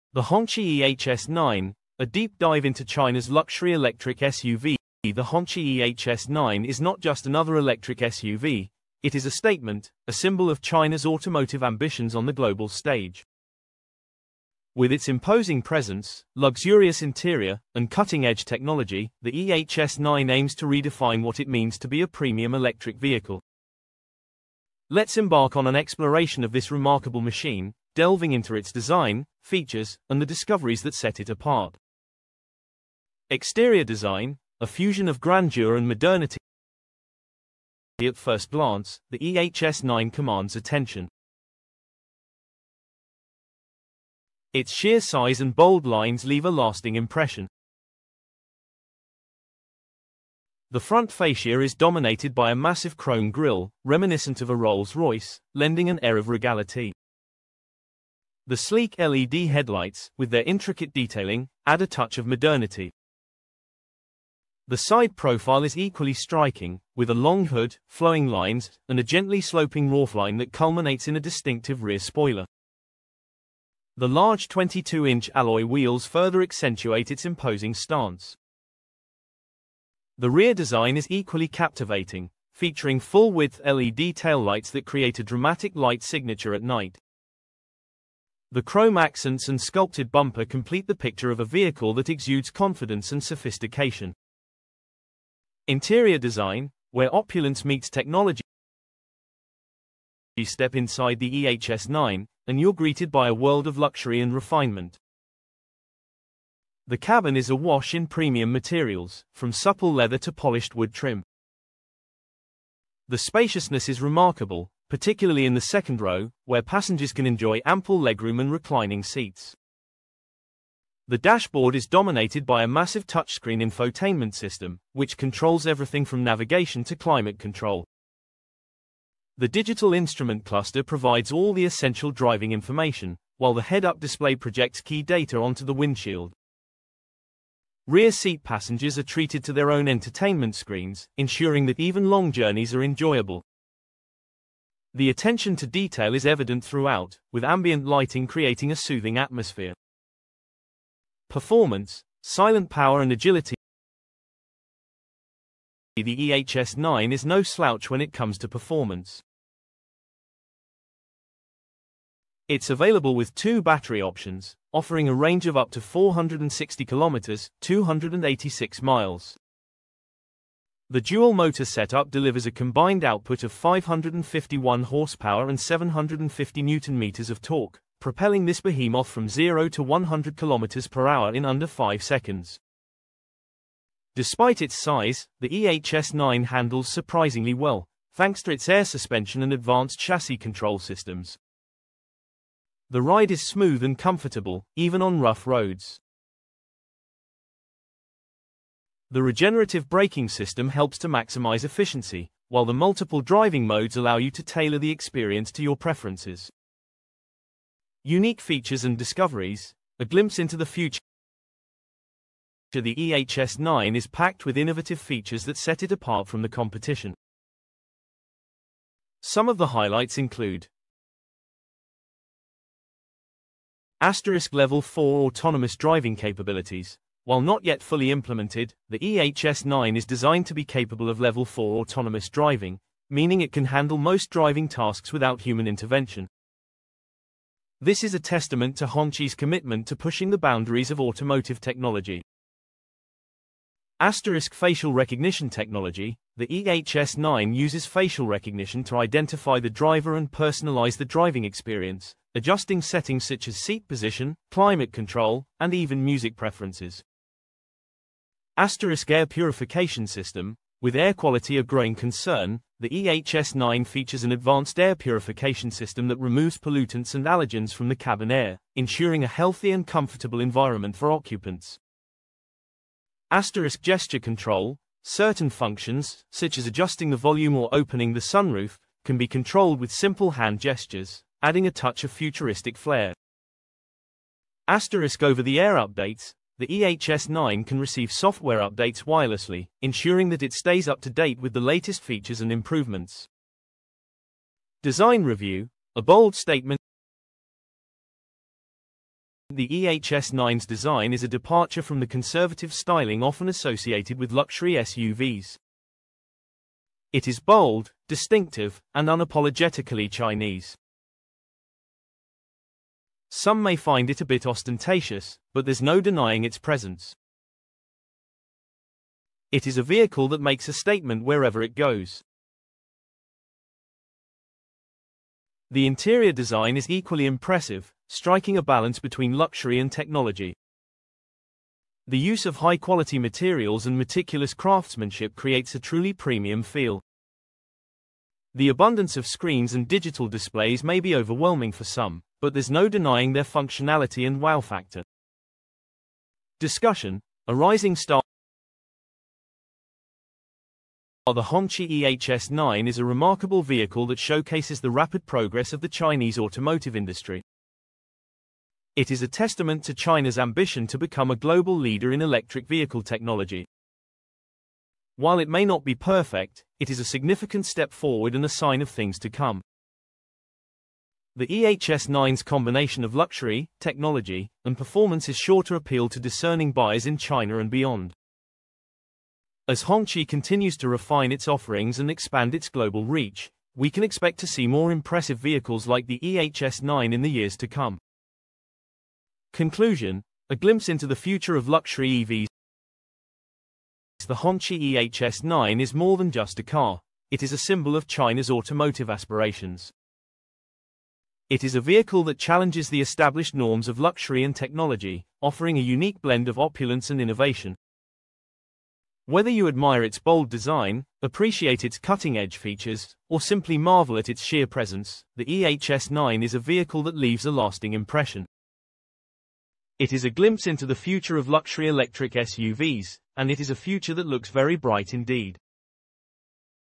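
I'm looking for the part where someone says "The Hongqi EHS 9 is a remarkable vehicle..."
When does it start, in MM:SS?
05:51.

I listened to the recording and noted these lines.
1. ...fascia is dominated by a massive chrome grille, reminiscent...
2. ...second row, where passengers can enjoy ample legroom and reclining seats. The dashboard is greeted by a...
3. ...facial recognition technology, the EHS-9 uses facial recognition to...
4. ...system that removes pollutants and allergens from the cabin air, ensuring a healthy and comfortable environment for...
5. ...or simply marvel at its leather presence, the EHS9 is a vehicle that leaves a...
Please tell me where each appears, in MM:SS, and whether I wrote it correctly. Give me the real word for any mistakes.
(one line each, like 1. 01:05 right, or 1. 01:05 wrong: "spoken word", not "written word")
1. 00:51 right
2. 01:55 wrong: "dominated", not "greeted"
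3. 04:04 right
4. 04:25 right
5. 06:53 wrong: "sheer", not "leather".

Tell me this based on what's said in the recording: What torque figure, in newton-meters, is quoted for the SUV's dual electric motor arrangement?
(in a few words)
750 newton-meters.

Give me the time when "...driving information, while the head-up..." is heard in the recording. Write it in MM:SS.
02:12.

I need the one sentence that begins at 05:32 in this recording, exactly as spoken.
The use of high-quality materials and meticulous craftsmanship creates a truly premium feel.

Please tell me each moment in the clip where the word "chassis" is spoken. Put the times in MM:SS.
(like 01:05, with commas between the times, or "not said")
03:09.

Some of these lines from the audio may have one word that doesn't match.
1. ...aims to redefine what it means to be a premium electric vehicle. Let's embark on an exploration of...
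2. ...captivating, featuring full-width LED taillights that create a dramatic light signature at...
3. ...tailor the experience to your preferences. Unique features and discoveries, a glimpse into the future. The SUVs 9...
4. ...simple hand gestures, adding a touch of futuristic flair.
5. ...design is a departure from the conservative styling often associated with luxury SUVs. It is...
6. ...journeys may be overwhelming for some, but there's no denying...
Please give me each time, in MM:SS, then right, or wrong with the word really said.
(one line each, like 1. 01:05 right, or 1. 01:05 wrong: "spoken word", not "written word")
1. 00:20 right
2. 01:21 right
3. 03:24 wrong: "EHS", not "SUVs"
4. 04:39 right
5. 05:00 right
6. 05:40 wrong: "displays", not "journeys".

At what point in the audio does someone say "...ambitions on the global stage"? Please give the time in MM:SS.
00:11.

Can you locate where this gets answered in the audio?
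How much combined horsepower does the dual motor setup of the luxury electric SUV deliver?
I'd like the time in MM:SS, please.
02:53.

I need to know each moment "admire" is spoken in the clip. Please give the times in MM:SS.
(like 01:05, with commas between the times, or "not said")
06:49.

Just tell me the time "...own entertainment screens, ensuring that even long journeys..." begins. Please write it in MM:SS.
02:19.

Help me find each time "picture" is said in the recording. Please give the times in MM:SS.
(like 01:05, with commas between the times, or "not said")
01:30.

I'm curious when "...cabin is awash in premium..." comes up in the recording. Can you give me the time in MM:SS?
01:46.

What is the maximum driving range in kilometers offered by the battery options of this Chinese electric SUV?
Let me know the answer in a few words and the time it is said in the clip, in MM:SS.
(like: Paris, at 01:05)
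460 kilometers, at 02:45.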